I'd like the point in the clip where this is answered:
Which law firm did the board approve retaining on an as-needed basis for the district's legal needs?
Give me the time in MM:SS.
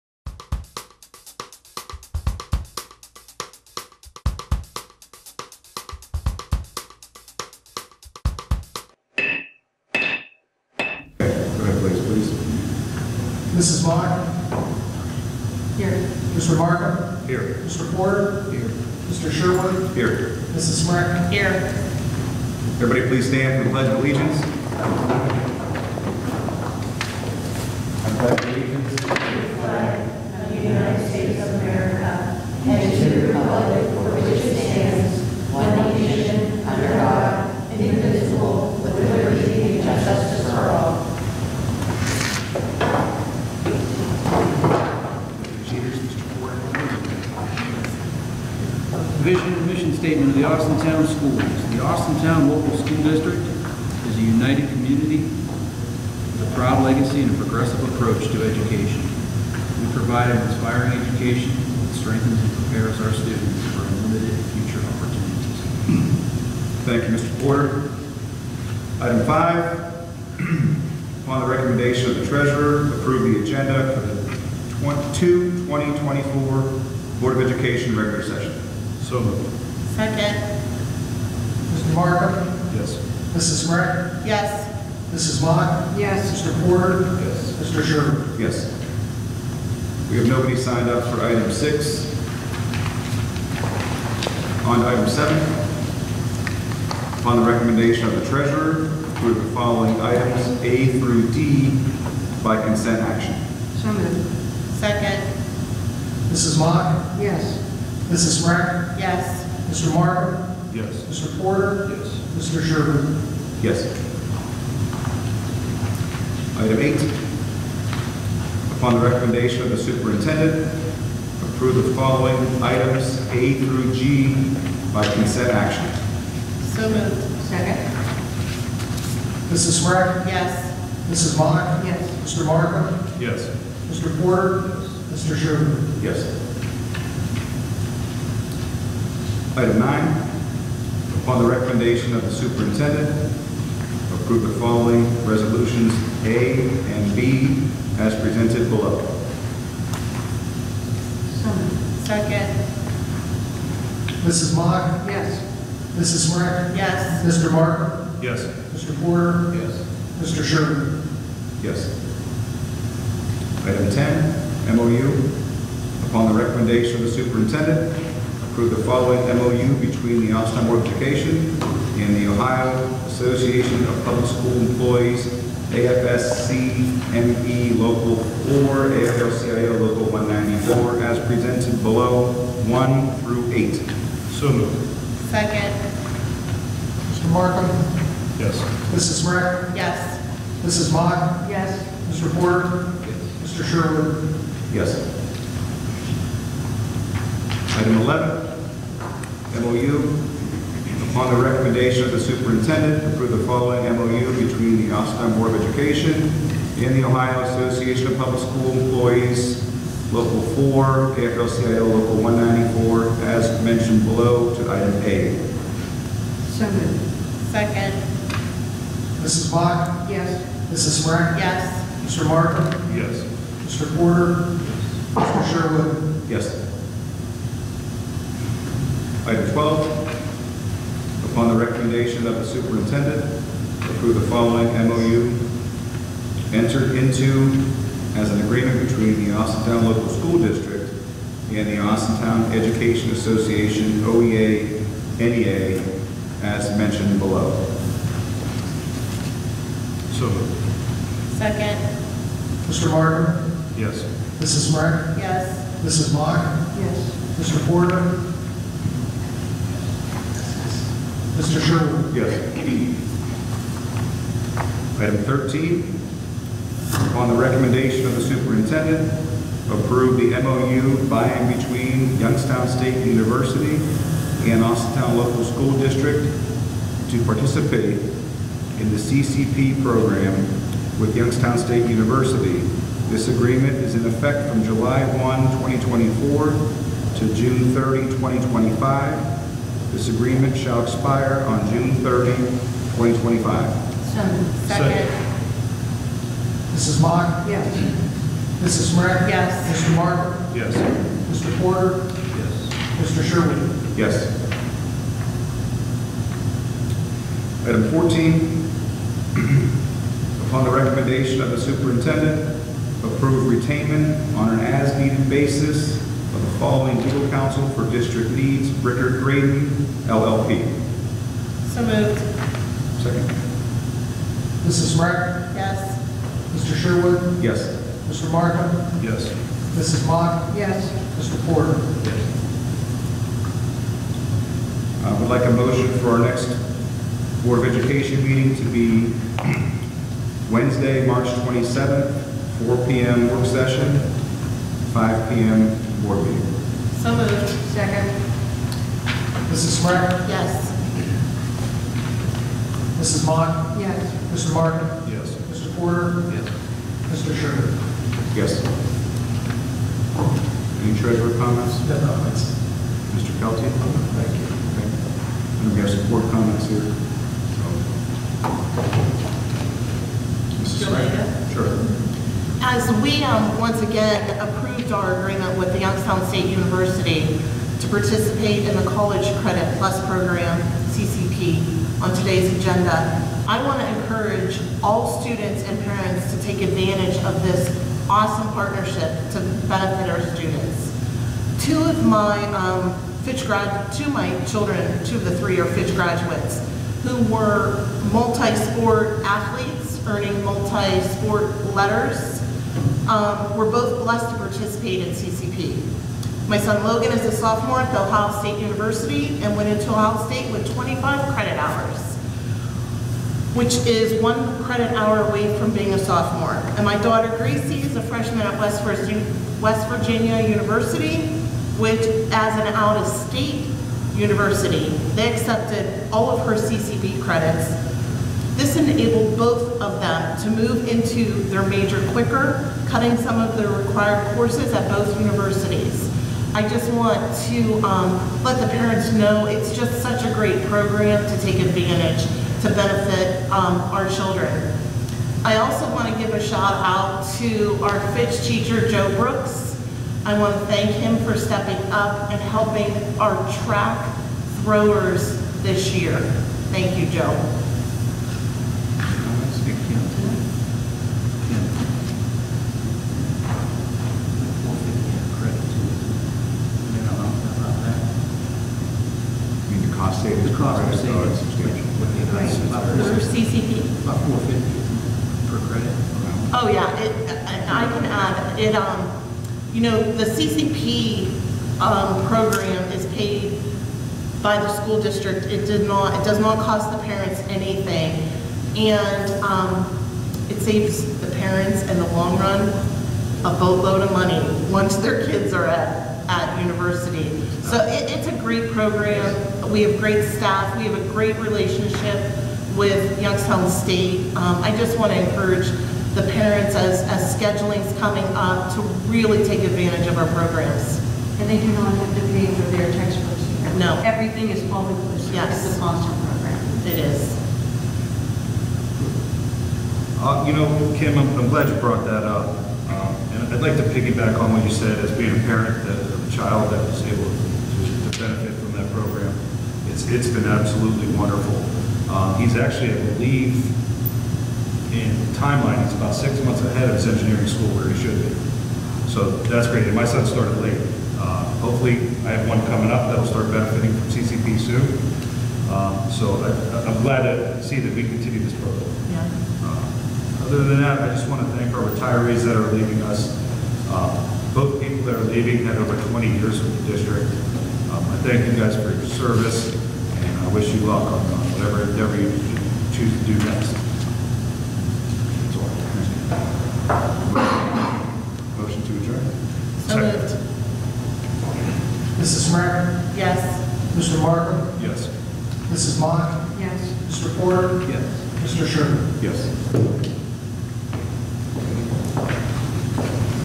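05:18.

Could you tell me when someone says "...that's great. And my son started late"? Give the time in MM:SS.
08:59.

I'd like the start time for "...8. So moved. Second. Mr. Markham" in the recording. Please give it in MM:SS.
03:03.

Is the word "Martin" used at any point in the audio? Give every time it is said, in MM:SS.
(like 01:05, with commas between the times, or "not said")
01:49, 02:37, 03:42, 04:12, 04:59, 05:54.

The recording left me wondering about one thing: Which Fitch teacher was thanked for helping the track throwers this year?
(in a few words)
Joe Brooks.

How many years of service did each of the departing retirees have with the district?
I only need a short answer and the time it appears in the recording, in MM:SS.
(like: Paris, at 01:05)
over 20 years, at 09:15.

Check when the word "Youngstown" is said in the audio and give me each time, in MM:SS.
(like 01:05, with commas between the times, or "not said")
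04:32, 04:41, 06:15, 08:23.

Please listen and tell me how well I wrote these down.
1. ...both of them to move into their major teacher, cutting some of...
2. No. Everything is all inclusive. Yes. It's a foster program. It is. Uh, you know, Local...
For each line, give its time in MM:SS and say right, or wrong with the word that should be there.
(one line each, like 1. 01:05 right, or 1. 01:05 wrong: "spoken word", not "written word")
1. 07:09 wrong: "quicker", not "teacher"
2. 08:33 wrong: "Kim", not "Local".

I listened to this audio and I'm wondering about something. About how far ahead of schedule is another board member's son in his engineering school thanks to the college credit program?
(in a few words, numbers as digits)
6 months.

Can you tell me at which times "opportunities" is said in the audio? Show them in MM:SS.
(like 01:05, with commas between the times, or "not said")
01:04.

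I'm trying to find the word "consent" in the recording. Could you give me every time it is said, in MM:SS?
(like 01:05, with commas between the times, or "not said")
01:42, 02:05.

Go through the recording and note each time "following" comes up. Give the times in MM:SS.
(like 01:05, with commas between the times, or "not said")
01:39, 02:01, 02:24, 02:48, 03:23, 03:54, 05:16.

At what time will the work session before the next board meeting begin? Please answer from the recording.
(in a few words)
4 p.m.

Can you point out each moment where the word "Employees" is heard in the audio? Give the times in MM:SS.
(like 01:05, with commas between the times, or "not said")
02:54, 03:28.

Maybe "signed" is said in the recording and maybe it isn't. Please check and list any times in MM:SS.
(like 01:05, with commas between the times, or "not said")
01:30.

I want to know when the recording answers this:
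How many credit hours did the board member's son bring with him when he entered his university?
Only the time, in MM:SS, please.
06:50.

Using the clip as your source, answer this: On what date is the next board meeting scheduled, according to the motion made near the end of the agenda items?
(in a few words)
March 27.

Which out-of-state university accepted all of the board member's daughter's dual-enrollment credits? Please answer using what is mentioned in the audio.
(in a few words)
West Virginia University.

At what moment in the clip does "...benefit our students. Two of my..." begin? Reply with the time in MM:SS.
06:29.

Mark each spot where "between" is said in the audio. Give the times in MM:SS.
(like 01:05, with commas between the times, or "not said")
02:49, 03:24, 03:58, 04:31.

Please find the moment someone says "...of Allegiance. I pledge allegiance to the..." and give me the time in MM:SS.
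00:23.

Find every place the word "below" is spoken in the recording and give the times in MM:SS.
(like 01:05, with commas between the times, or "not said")
02:28, 03:01, 03:34, 04:07.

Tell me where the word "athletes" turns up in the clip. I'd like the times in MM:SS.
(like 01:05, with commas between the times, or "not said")
06:39.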